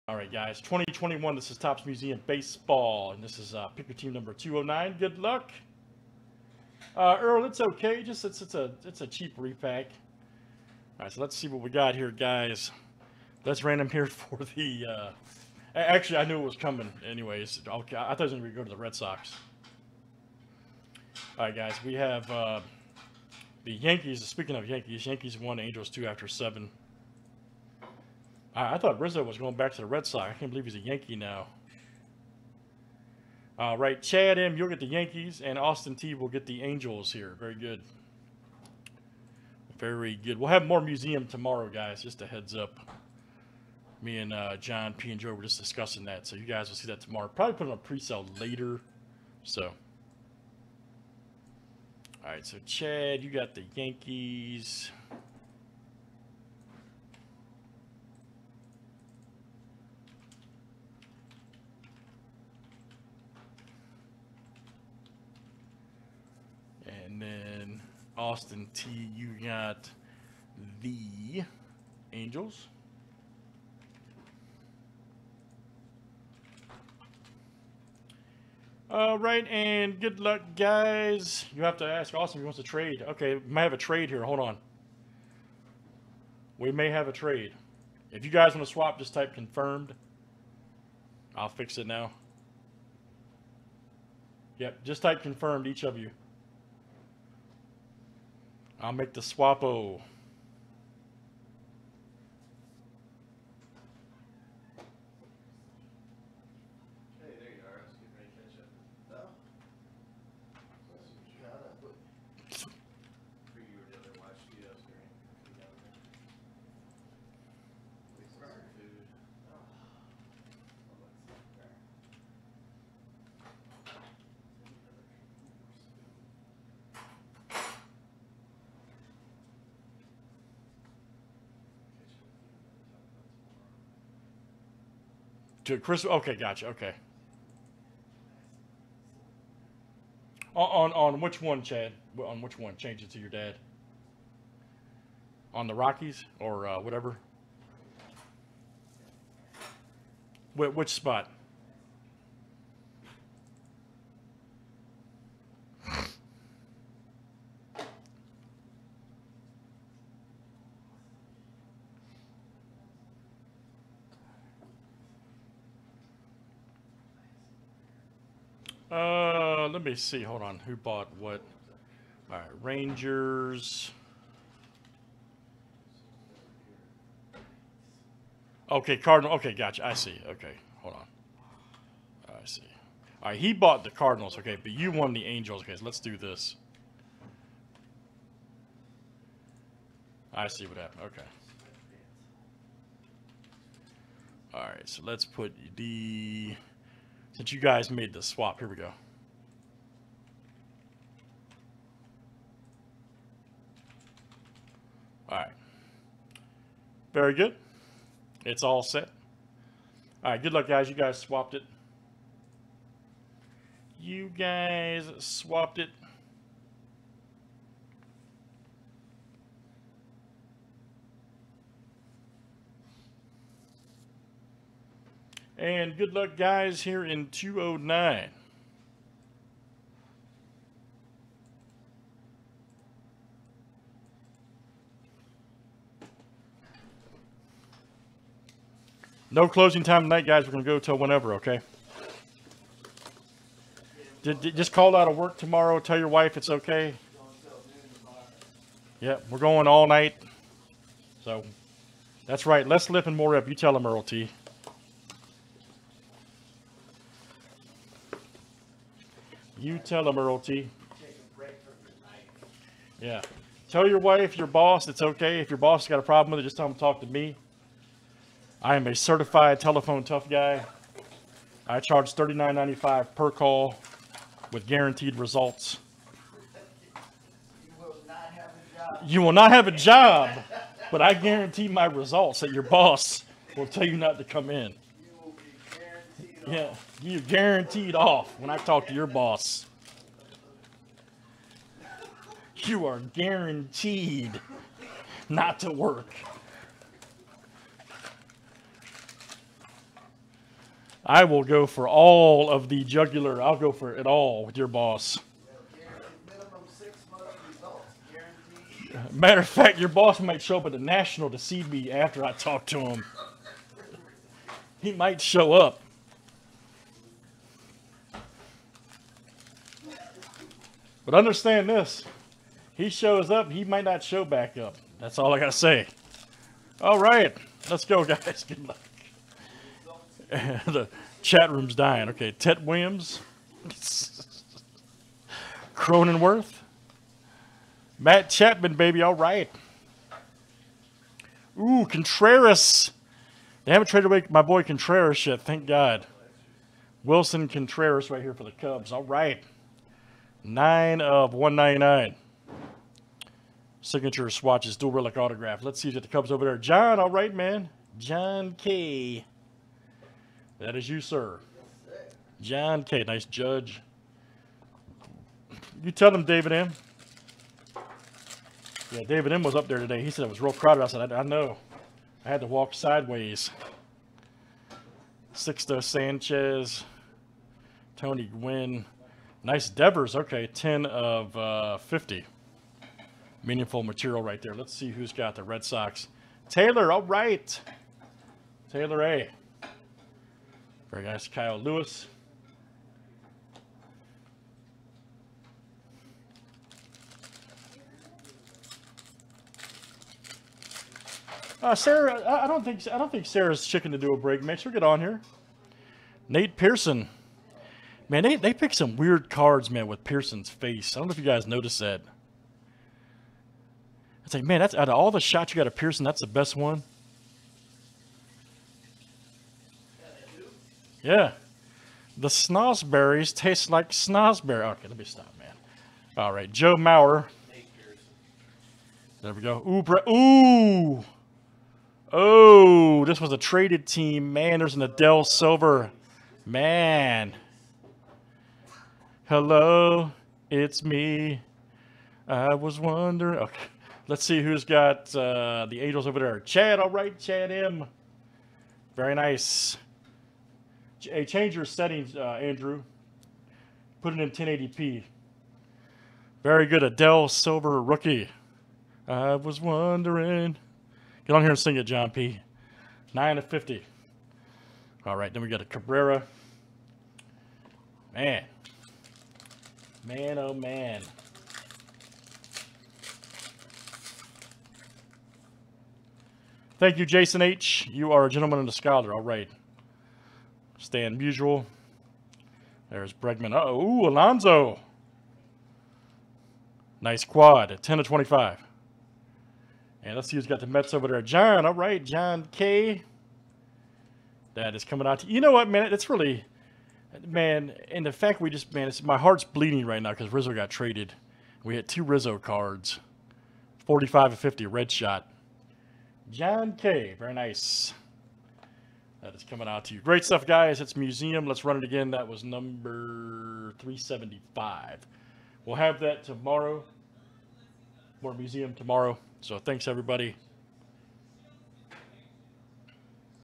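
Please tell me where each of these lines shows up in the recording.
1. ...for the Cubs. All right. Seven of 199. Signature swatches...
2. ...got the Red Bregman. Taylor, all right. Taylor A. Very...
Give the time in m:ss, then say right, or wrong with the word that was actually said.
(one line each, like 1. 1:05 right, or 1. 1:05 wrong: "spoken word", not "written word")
1. 5:48 wrong: "Nine", not "Seven"
2. 6:25 wrong: "Sox", not "Bregman".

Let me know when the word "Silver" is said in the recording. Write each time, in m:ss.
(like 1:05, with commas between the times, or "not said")
7:15, 7:37.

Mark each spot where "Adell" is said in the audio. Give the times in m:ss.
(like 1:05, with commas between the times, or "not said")
7:14, 7:36.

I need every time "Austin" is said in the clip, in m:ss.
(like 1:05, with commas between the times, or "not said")
0:35, 1:08, 1:22.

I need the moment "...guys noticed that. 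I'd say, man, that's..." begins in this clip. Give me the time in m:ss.
6:51.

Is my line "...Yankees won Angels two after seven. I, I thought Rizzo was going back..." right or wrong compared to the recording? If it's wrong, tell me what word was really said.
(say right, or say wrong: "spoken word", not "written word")
right.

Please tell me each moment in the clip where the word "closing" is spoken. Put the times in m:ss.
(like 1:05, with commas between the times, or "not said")
3:59.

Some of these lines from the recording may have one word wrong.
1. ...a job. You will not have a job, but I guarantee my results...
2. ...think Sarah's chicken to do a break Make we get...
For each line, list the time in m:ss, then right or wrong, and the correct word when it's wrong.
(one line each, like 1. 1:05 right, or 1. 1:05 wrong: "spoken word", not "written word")
1. 4:38 right
2. 6:43 right.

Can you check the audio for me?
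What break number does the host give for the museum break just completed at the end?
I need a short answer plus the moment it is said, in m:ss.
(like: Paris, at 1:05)
375, at 8:33.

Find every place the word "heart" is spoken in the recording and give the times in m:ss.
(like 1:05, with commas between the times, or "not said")
8:19.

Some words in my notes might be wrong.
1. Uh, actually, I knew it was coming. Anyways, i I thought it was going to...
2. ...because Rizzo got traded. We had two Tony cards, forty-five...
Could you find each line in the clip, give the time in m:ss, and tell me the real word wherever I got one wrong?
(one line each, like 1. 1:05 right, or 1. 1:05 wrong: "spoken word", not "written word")
1. 0:14 right
2. 8:20 wrong: "Rizzo", not "Tony".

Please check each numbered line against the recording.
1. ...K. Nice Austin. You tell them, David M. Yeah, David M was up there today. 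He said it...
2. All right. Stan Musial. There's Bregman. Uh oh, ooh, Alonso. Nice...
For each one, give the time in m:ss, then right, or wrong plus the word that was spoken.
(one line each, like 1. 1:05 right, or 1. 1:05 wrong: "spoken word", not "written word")
1. 6:02 wrong: "Judge", not "Austin"
2. 7:59 right.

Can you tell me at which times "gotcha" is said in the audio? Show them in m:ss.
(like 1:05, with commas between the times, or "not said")
2:16, 2:59.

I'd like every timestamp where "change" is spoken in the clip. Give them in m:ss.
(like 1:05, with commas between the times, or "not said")
2:22, 7:31.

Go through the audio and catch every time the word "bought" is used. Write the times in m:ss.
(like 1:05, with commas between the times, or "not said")
2:50, 3:03.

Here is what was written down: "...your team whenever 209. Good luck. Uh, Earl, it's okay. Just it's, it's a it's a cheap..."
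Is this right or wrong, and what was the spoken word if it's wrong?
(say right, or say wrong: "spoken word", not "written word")
wrong: "number", not "whenever".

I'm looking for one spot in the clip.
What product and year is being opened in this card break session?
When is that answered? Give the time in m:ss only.
0:00.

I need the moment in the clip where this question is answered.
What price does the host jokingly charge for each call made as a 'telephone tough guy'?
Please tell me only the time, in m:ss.
4:32.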